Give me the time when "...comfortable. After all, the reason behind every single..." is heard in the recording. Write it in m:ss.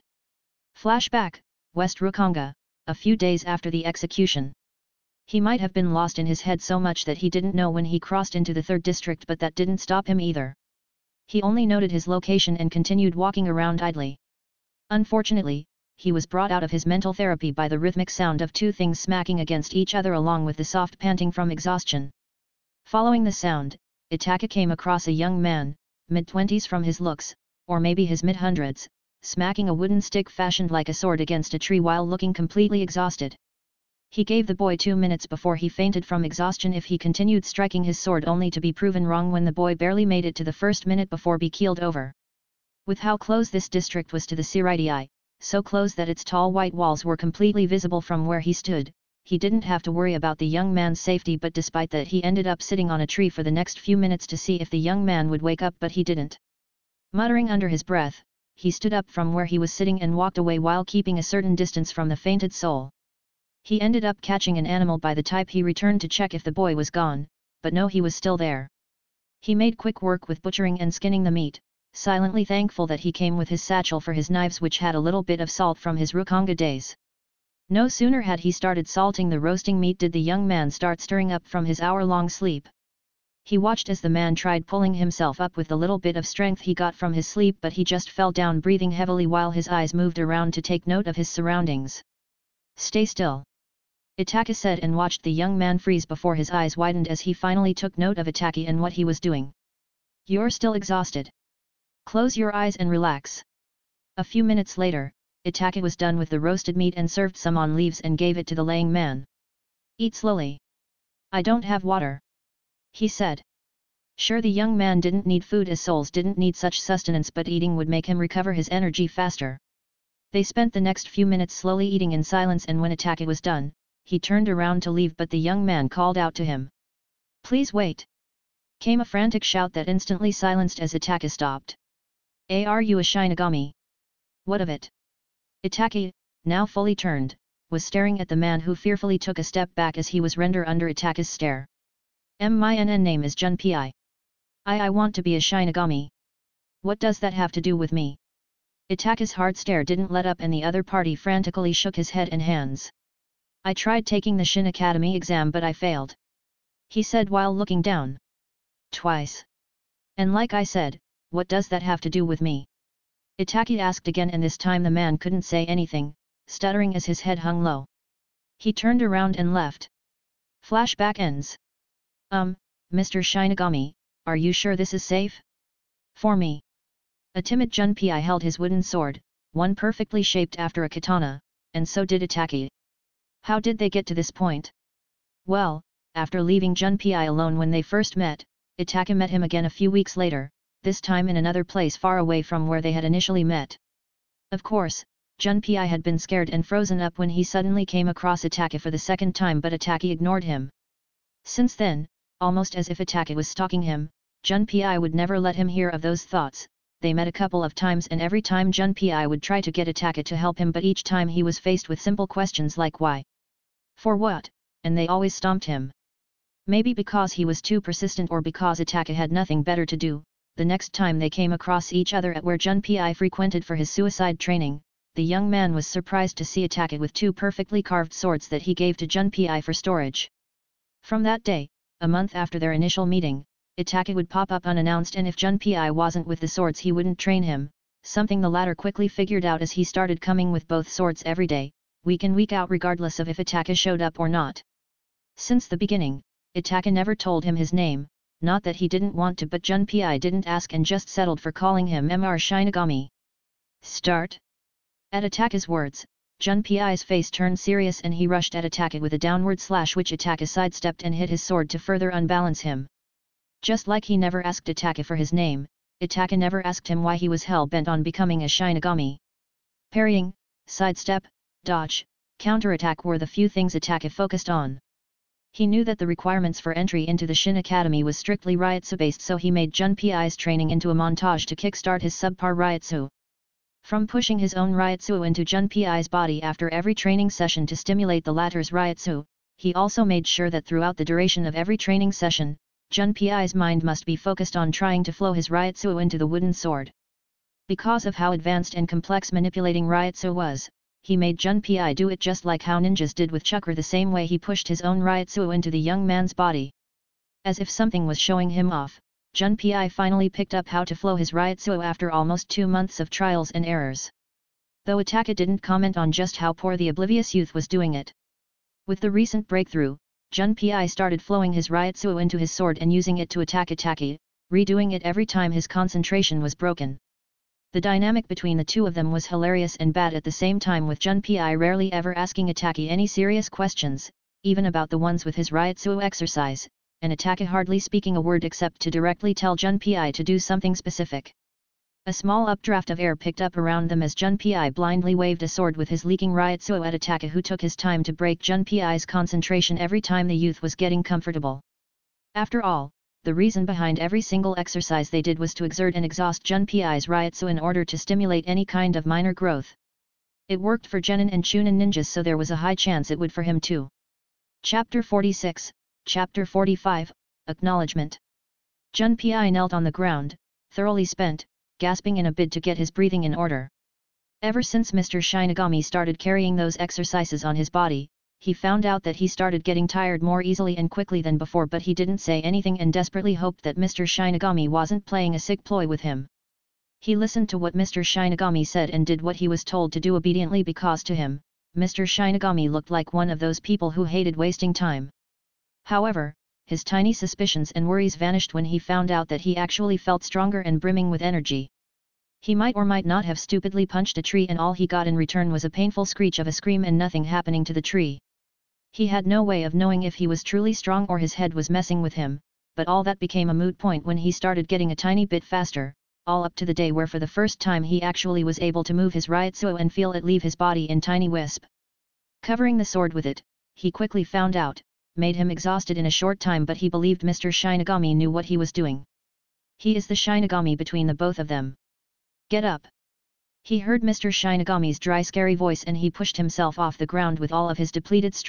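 5:51.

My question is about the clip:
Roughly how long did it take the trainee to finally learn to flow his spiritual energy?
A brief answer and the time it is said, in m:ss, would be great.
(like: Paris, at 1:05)
Almost two months, at 5:12.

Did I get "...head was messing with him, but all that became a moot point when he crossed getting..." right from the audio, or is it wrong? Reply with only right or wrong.
wrong.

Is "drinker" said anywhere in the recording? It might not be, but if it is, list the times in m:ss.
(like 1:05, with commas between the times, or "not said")
not said.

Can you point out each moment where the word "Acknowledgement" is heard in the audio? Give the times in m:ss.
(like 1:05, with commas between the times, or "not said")
6:07.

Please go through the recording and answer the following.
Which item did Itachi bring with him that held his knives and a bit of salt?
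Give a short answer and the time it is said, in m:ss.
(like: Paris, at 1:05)
His satchel, at 1:13.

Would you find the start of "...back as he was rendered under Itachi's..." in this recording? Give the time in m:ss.
2:19.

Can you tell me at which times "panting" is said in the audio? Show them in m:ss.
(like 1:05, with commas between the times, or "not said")
0:20.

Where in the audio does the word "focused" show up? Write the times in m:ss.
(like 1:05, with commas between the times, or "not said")
4:34, 4:54.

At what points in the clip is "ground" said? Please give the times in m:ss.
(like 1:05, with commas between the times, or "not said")
6:09, 7:17.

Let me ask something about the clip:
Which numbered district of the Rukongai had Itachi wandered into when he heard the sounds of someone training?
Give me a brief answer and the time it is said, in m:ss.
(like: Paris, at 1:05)
3rd district, at 0:08.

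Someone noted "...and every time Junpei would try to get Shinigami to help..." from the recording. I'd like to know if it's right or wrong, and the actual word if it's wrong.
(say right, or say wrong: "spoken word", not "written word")
wrong: "Itachi", not "Shinigami".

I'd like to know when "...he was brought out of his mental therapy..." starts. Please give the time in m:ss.
0:15.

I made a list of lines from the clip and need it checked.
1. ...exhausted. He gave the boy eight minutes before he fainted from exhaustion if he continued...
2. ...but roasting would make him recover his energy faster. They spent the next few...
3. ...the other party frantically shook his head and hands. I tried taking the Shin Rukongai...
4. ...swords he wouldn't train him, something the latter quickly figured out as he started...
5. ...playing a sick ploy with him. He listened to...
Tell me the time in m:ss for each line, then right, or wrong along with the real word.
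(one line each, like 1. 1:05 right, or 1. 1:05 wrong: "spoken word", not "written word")
1. 0:32 wrong: "two", not "eight"
2. 1:57 wrong: "eating", not "roasting"
3. 2:30 wrong: "Academy", not "Rukongai"
4. 3:56 right
5. 6:25 right.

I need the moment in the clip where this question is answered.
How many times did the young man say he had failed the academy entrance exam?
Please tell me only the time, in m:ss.
2:38.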